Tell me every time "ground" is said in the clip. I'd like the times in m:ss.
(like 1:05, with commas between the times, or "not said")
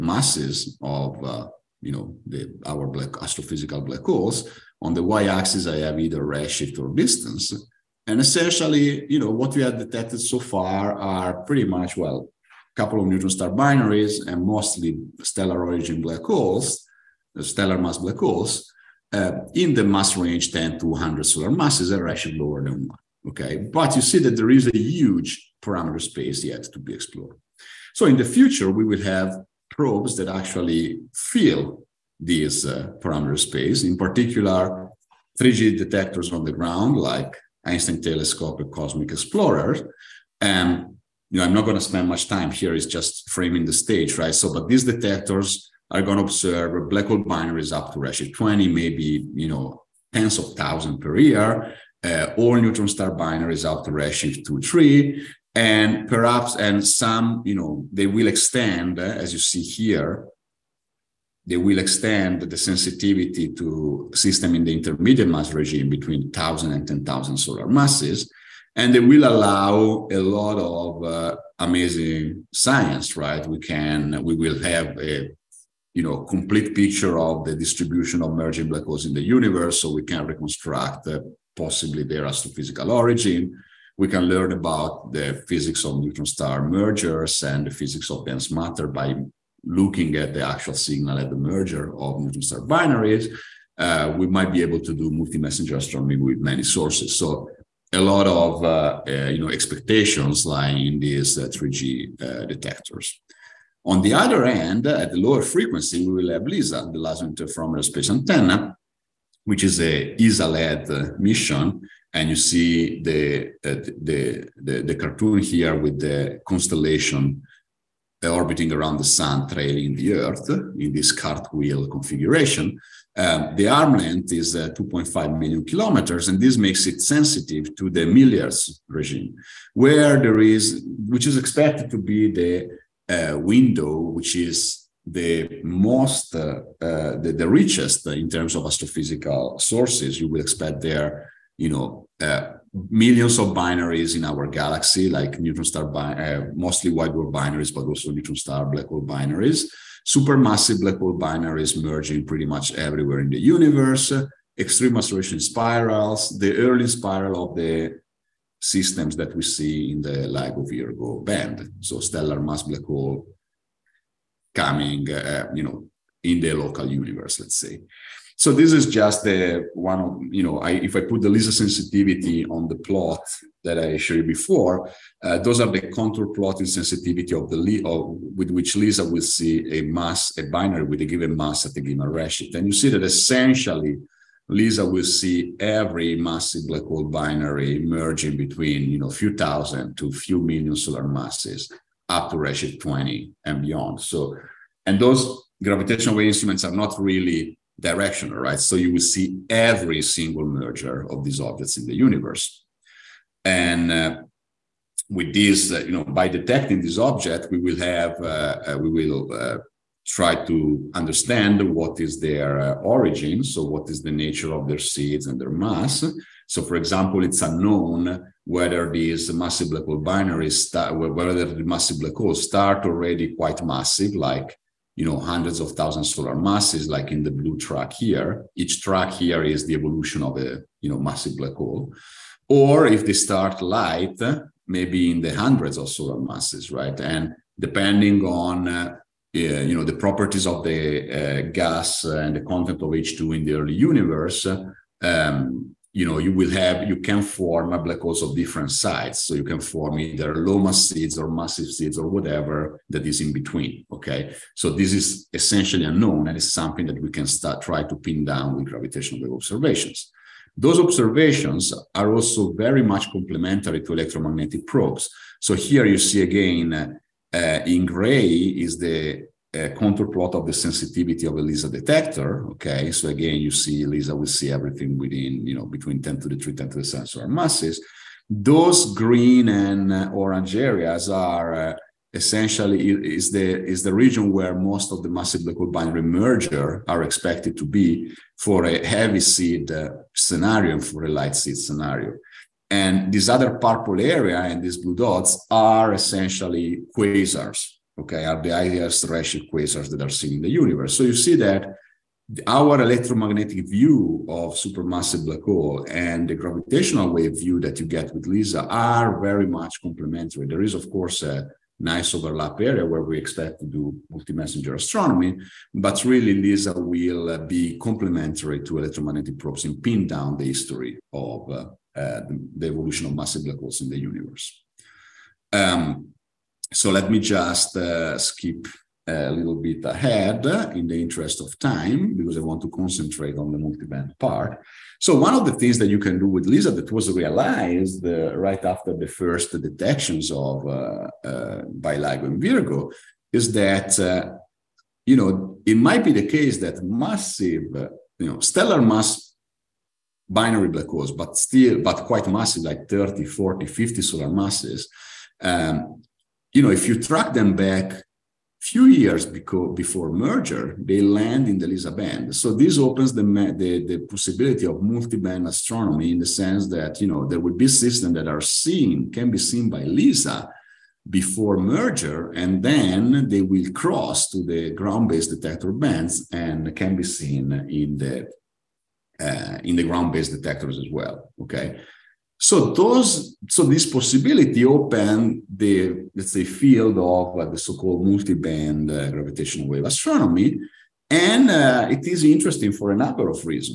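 0:36, 6:14, 6:19.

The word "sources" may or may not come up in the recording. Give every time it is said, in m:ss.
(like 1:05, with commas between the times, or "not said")
1:36, 2:19.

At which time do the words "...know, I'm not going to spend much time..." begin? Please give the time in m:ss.
0:41.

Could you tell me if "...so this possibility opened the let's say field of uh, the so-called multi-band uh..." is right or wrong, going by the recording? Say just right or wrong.
right.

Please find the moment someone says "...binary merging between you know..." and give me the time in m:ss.
3:07.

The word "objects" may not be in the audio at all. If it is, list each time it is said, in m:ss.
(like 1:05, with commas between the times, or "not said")
3:21, 3:26.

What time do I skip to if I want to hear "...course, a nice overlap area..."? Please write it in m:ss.
5:10.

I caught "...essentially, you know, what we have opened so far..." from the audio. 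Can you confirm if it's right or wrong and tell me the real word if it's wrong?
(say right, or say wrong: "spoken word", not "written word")
wrong: "detected", not "opened".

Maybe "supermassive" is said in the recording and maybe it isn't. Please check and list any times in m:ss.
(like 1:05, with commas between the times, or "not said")
2:30, 5:04.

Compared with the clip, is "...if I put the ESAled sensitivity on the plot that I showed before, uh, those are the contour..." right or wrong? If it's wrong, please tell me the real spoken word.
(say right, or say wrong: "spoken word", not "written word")
wrong: "LISA", not "ESAled".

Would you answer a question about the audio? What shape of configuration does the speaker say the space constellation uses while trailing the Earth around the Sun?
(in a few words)
cartwheel.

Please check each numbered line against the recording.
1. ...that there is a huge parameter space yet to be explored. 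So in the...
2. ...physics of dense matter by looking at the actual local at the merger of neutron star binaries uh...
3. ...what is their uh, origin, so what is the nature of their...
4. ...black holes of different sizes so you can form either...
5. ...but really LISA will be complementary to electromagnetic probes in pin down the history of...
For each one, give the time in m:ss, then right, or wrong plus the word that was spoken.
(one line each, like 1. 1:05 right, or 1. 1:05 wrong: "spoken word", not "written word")
1. 0:24 right
2. 1:27 wrong: "signal", not "local"
3. 3:31 right
4. 4:07 right
5. 5:15 right.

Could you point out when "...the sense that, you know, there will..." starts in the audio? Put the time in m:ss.
6:06.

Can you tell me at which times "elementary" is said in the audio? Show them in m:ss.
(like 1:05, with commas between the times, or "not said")
not said.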